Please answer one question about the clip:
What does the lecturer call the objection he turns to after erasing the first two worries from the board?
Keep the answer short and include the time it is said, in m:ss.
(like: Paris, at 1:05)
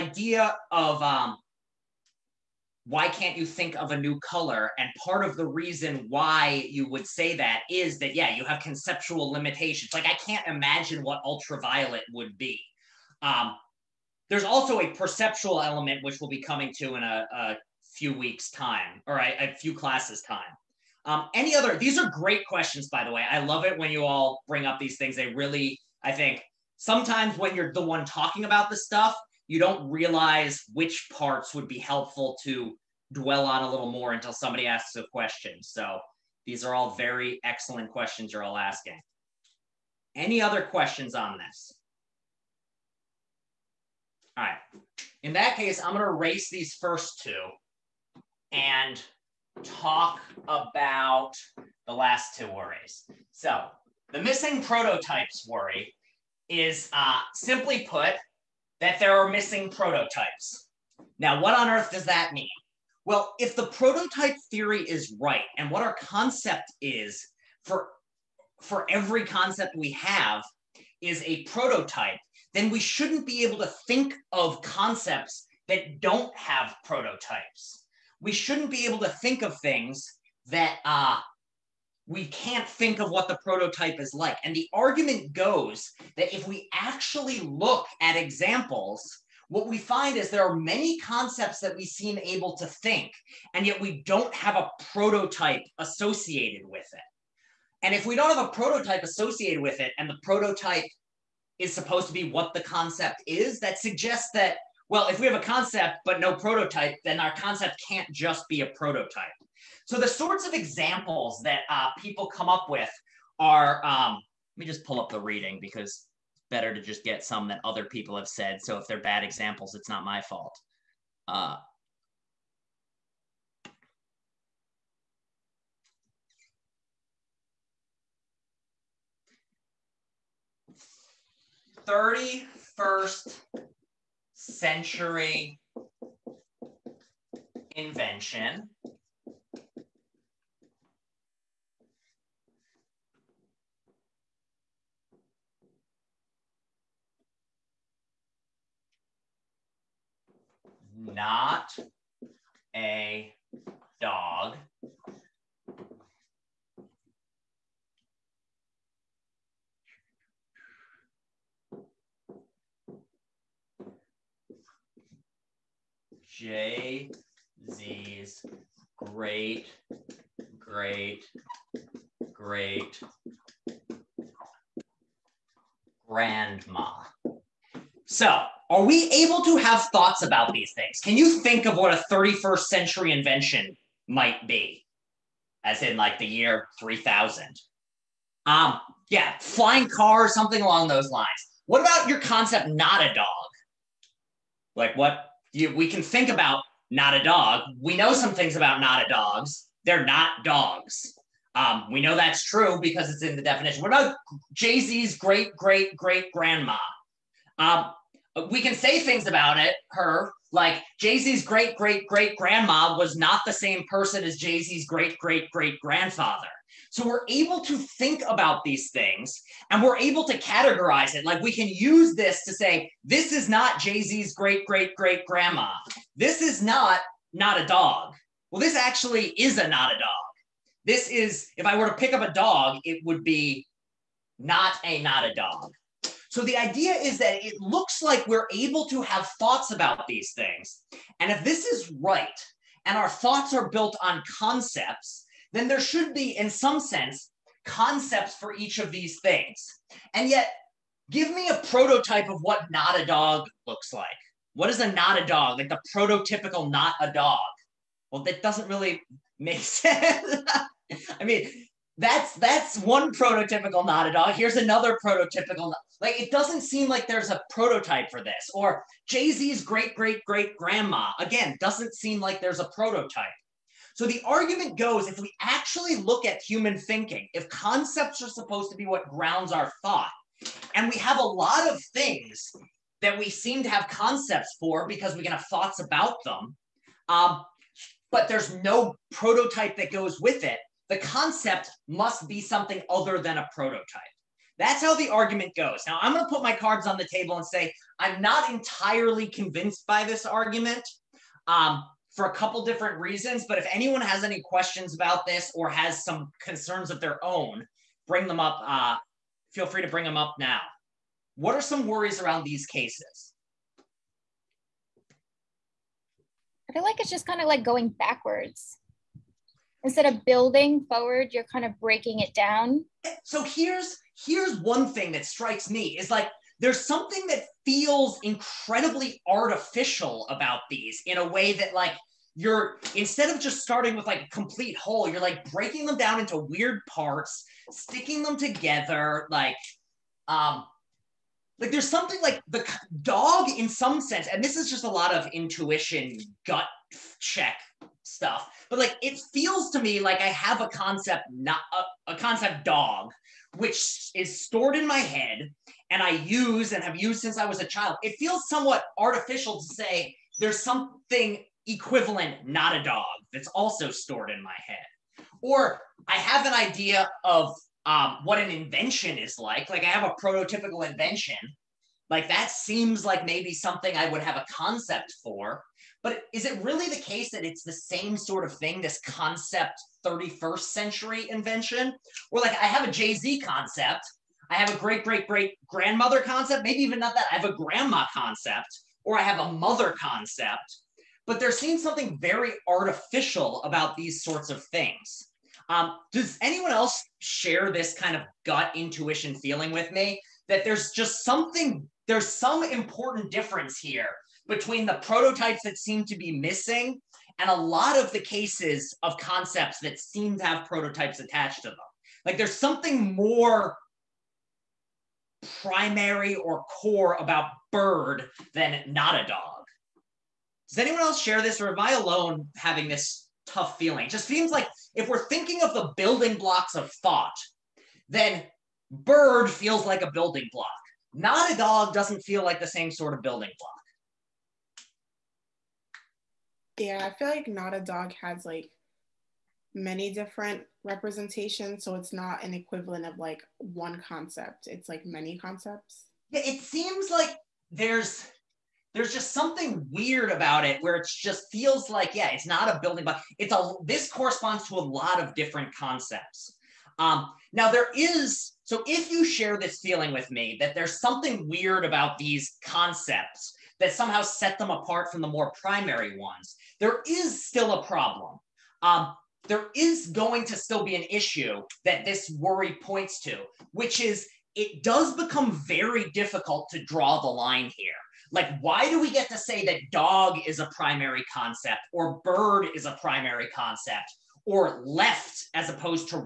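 missing prototypes worry, at 0:54.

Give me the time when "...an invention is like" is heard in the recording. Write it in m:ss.
6:08.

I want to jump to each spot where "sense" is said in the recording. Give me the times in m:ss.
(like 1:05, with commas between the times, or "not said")
4:06, 4:19, 5:44.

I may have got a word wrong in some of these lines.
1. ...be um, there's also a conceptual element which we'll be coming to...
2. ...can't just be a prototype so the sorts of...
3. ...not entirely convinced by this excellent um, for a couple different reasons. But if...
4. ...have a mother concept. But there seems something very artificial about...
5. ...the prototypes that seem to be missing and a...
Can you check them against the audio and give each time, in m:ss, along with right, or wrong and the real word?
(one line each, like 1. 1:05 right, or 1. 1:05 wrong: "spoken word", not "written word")
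1. 0:12 wrong: "perceptual", not "conceptual"
2. 1:47 right
3. 4:58 wrong: "argument", not "excellent"
4. 6:29 right
5. 6:44 right.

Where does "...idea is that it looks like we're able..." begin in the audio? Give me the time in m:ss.
3:56.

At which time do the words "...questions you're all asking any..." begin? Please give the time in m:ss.
0:37.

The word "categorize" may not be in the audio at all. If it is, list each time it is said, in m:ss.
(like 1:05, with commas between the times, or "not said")
3:40.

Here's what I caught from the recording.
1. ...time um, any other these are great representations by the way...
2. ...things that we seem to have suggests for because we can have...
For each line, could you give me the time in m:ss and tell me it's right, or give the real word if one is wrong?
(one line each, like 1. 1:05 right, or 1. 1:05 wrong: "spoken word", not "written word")
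1. 0:20 wrong: "questions", not "representations"
2. 4:41 wrong: "concepts", not "suggests".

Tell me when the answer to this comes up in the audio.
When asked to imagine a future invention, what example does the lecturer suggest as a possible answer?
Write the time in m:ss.
3:09.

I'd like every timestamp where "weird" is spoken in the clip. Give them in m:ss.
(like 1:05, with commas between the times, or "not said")
5:36, 7:29, 7:41.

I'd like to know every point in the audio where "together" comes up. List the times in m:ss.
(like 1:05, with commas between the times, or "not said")
5:38.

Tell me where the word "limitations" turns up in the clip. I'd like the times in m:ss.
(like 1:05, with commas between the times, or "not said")
0:09.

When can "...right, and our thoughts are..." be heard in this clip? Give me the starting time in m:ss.
4:02.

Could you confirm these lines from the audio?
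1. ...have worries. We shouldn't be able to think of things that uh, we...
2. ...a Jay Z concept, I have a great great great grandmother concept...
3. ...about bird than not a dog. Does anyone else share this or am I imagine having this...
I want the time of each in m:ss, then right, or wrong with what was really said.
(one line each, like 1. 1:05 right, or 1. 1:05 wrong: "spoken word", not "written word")
1. 1:16 wrong: "prototypes", not "worries"
2. 6:22 right
3. 6:57 wrong: "alone", not "imagine".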